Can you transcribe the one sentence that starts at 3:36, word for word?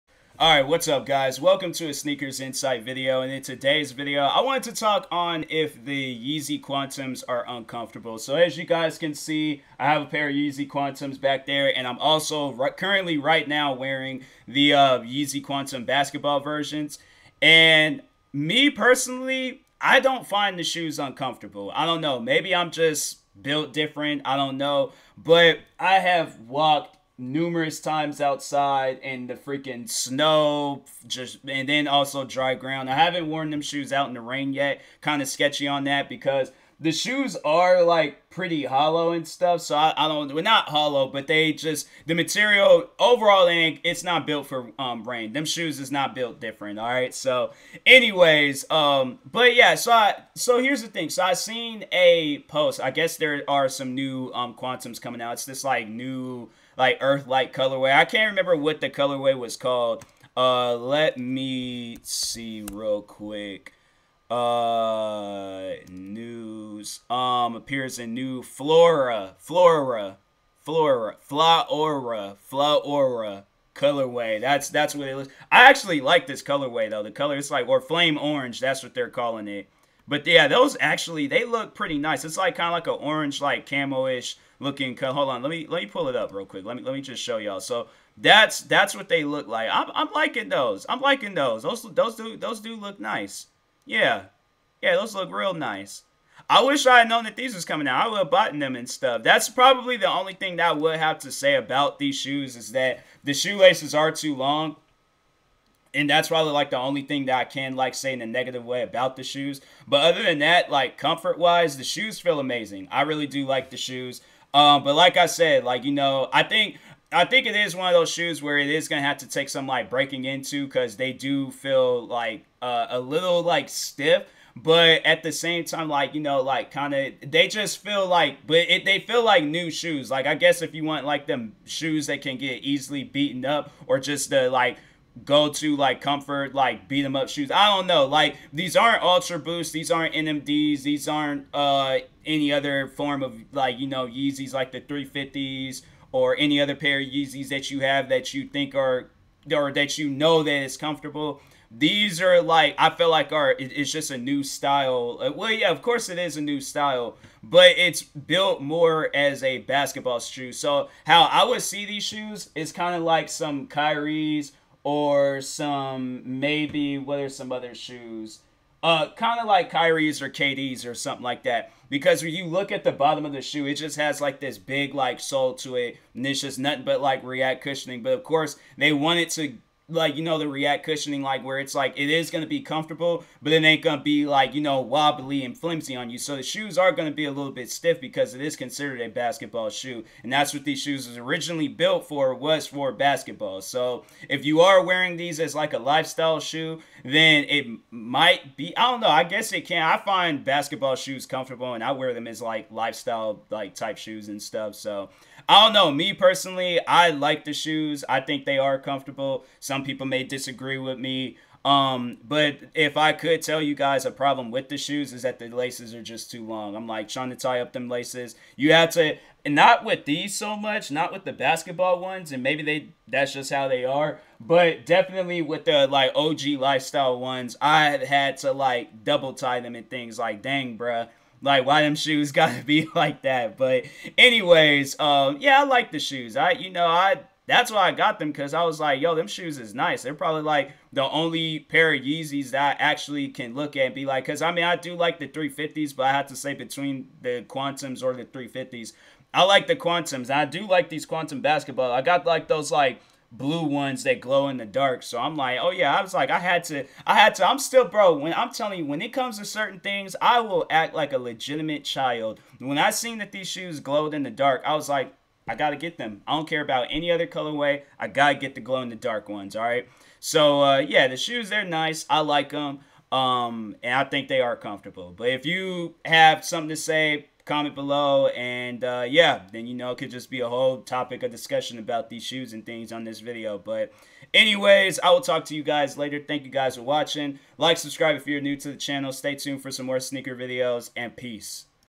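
I'm like trying to tie up them laces.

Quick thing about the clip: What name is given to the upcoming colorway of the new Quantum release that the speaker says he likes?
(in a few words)
Flame orange.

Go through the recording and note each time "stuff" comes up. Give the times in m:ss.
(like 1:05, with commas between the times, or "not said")
0:39, 1:38, 3:24.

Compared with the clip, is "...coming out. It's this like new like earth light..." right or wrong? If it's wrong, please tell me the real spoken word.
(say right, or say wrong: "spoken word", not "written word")
right.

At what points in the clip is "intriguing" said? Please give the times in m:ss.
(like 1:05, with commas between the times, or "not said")
not said.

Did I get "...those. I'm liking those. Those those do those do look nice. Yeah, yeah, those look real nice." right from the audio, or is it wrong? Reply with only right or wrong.
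right.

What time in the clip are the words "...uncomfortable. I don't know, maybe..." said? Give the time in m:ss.
0:20.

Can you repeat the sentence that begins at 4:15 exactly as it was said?
So I'm like, oh yeah, I was like, I had to, I had to.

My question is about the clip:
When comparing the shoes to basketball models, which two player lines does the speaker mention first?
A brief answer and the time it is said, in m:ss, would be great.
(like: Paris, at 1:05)
Kyrie's or KD's, at 2:49.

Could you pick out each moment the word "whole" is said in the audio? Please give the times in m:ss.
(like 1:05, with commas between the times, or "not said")
4:40.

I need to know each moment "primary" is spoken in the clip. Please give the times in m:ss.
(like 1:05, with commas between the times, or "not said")
not said.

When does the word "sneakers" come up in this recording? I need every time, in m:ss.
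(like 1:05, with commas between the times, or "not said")
0:01, 4:49.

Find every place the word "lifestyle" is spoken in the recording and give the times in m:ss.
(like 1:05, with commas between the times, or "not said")
3:15, 3:22, 3:46.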